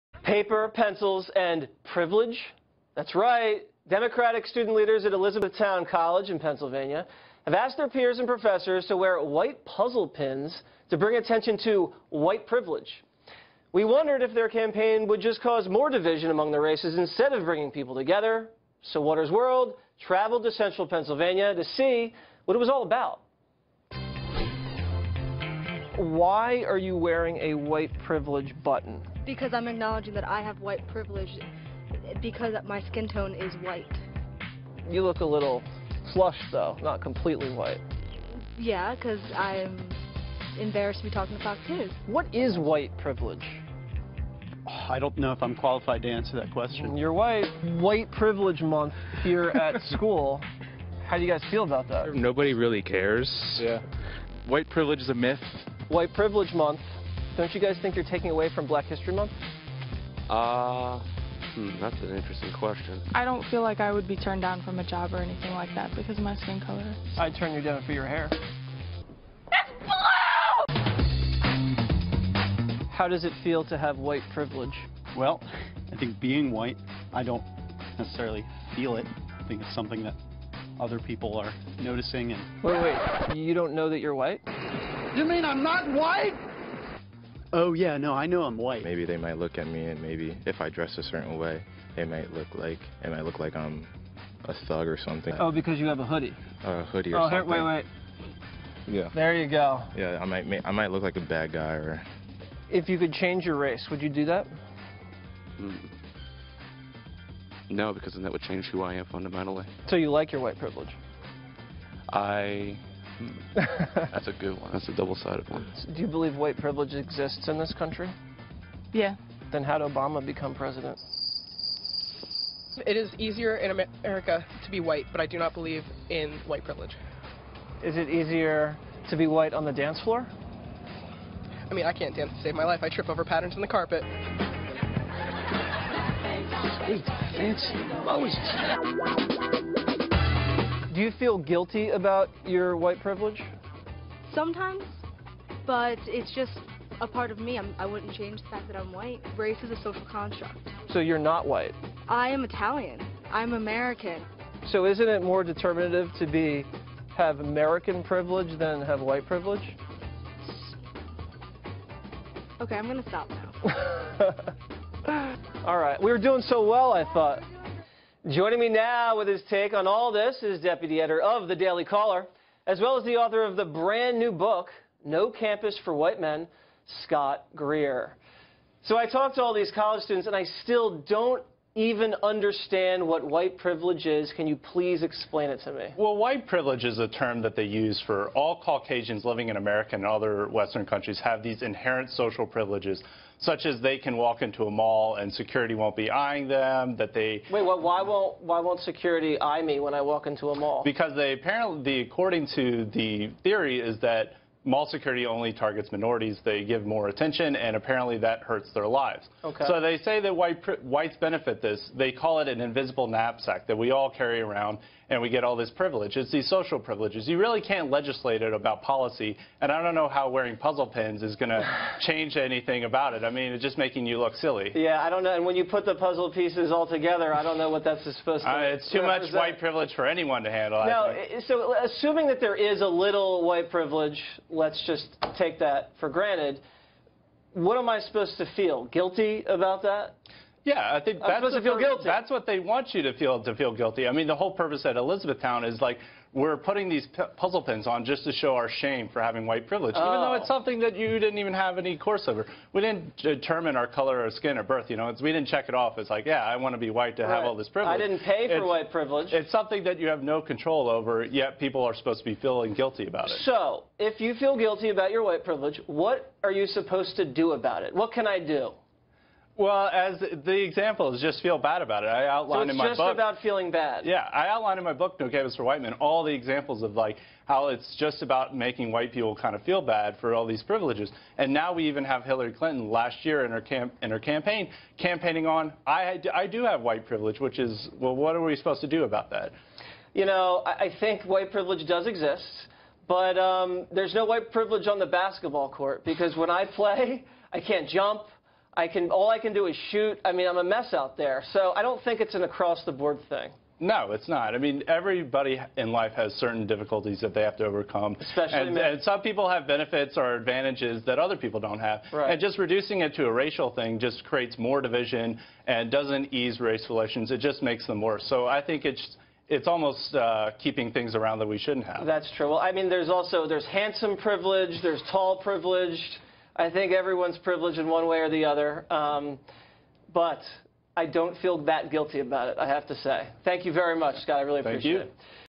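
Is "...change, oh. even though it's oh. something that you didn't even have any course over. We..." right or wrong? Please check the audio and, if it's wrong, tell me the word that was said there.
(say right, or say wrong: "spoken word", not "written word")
wrong: "privilege", not "change".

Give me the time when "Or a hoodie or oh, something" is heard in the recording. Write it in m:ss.
1:36.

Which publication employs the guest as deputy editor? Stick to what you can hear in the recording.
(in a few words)
The Daily Caller.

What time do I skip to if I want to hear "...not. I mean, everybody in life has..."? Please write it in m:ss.
5:04.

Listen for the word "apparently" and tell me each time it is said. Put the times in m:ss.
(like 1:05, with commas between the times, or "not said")
3:21, 3:27.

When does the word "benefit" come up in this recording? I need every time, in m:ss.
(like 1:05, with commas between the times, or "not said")
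3:31, 5:09.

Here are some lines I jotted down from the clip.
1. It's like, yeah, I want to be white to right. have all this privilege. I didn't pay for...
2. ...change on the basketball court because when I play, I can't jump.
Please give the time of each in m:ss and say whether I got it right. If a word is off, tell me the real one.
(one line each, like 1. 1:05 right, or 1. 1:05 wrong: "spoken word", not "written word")
1. 4:15 right
2. 4:54 wrong: "privilege", not "change".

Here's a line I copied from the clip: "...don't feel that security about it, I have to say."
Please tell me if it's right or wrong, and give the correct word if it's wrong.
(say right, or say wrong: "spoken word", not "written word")
wrong: "guilty", not "security".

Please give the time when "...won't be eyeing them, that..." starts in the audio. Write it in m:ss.
3:15.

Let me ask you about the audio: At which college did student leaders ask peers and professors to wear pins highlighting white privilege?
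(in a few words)
Elizabethtown College.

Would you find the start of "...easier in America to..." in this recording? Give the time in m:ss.
2:03.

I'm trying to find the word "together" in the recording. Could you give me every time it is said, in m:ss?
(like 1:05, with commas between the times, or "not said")
0:17, 3:46.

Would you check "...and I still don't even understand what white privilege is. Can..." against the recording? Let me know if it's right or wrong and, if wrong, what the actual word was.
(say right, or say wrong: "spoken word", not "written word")
right.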